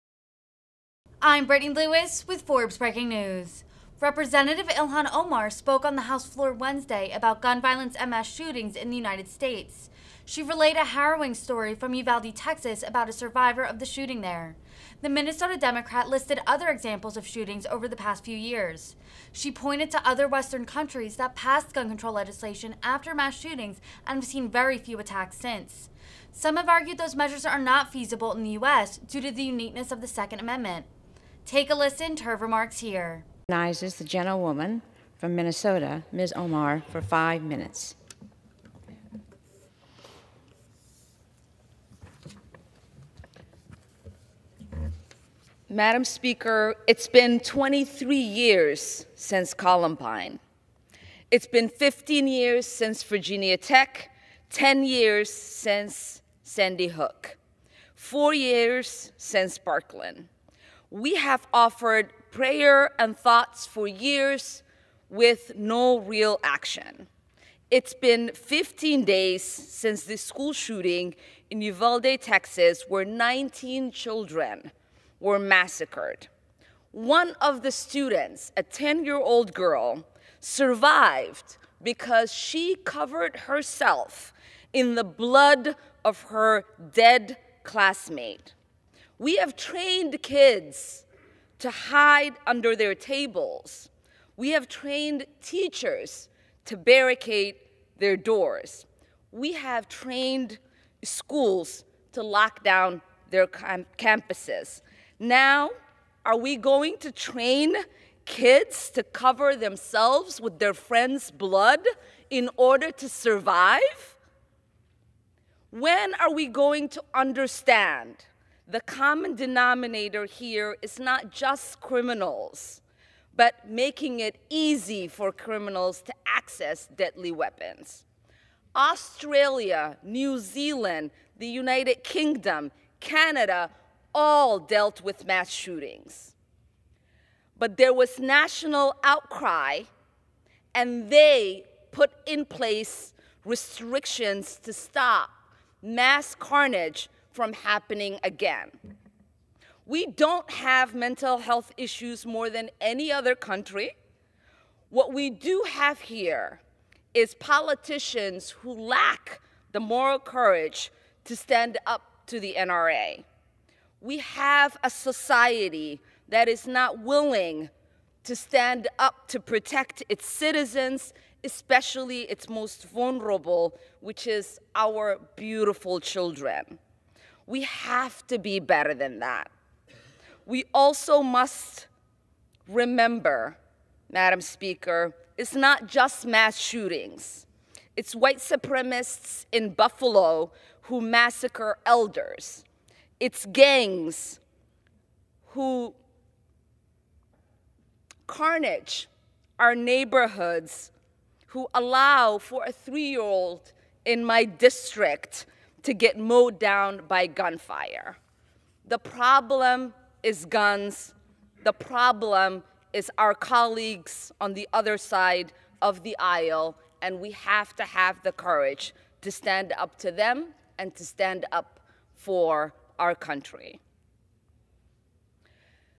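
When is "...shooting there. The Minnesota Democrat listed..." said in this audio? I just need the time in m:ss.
0:13.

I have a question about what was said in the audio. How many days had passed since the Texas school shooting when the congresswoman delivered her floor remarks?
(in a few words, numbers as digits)
15 days.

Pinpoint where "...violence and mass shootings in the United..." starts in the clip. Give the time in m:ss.
0:07.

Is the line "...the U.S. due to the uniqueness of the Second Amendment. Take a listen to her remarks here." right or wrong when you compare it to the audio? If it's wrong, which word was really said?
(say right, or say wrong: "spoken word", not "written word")
right.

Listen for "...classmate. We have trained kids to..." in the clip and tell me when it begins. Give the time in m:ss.
1:27.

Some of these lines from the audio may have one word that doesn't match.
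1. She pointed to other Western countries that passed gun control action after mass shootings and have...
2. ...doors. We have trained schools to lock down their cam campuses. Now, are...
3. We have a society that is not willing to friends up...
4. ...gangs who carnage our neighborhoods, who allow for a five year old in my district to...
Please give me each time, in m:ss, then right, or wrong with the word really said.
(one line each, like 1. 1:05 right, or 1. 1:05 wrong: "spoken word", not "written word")
1. 0:19 wrong: "legislation", not "action"
2. 1:38 right
3. 2:44 wrong: "stand", not "friends"
4. 3:13 wrong: "three", not "five".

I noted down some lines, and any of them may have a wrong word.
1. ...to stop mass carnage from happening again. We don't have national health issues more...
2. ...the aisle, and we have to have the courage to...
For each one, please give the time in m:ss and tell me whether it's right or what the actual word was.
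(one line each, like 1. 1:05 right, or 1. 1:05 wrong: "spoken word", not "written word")
1. 2:24 wrong: "mental", not "national"
2. 3:36 right.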